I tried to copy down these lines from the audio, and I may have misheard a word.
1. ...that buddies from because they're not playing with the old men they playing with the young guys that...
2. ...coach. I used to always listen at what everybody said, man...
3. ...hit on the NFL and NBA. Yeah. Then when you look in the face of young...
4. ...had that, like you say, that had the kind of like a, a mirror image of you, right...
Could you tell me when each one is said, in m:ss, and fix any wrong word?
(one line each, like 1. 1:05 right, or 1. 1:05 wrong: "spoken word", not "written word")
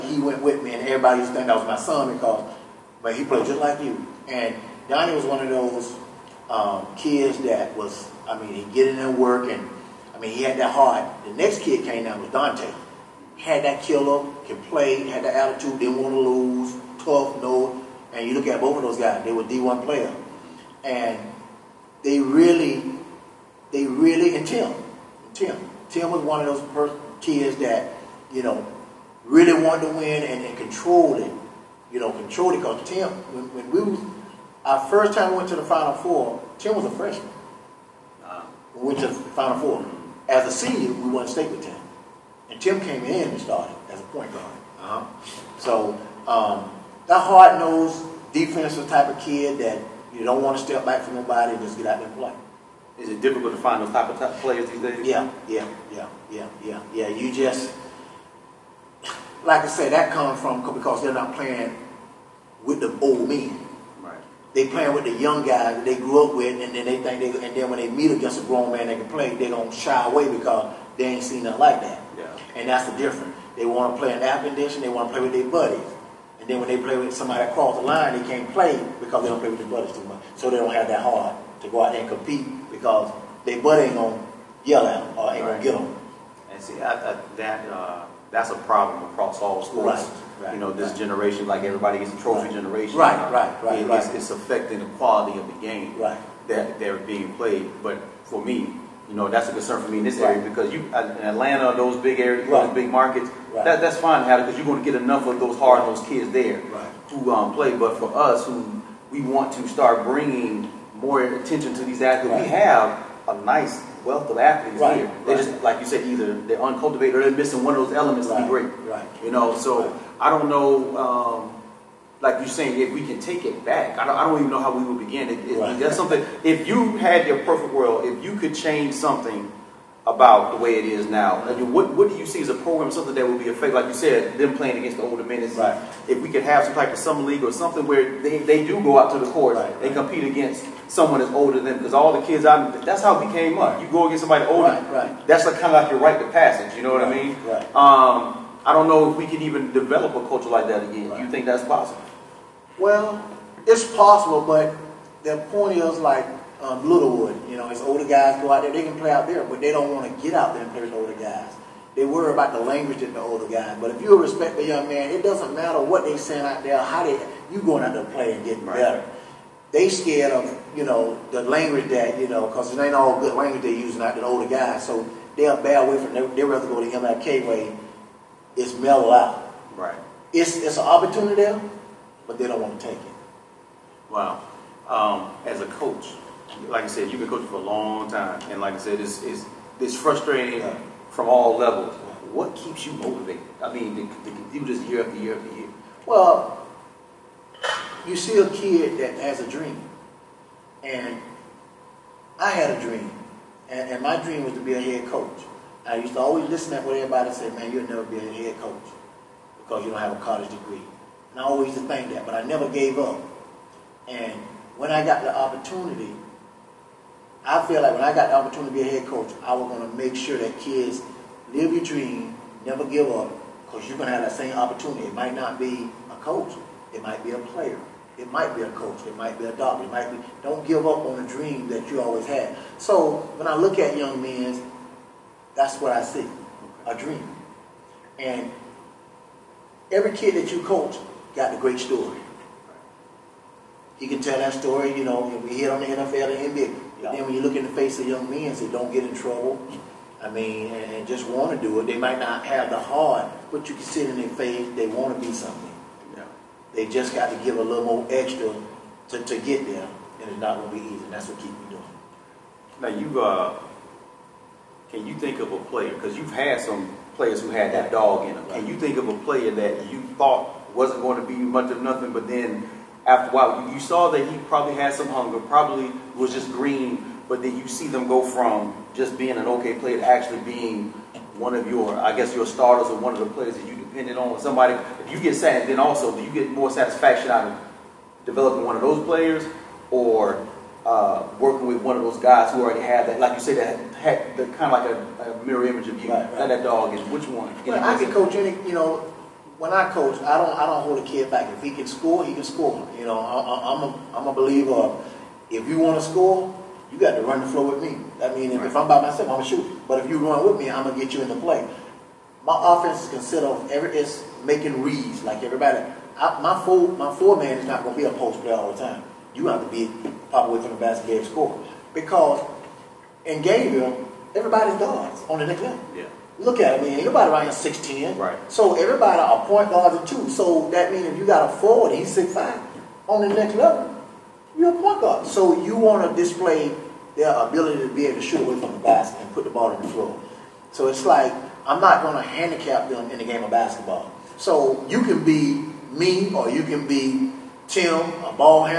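1. 0:59 wrong: "comes", not "buddies"
2. 3:25 right
3. 4:05 right
4. 4:52 right.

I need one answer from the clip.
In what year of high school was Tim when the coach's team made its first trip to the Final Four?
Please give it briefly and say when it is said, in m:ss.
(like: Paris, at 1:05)
Freshman, at 0:36.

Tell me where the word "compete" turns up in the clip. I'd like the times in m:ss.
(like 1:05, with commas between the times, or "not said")
1:22, 2:19.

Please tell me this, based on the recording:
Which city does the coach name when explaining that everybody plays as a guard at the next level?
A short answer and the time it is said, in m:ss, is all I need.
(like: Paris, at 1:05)
Gainesville, at 5:23.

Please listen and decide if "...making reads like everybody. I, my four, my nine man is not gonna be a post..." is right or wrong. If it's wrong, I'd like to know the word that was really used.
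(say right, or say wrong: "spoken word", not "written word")
wrong: "four", not "nine".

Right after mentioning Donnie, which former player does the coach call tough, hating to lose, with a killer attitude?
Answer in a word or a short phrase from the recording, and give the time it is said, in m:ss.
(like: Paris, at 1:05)
Dante, at 0:12.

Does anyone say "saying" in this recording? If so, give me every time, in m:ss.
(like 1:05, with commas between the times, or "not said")
2:02, 2:46.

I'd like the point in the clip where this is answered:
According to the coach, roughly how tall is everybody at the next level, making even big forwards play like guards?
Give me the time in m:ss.
5:27.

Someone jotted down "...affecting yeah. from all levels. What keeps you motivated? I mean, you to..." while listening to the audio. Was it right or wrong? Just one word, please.
wrong.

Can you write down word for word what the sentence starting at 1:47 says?
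But for us, who we want to start bringing more attention to these athletes, we have a nice wealth of athletes here.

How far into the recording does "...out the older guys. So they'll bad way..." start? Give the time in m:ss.
2:54.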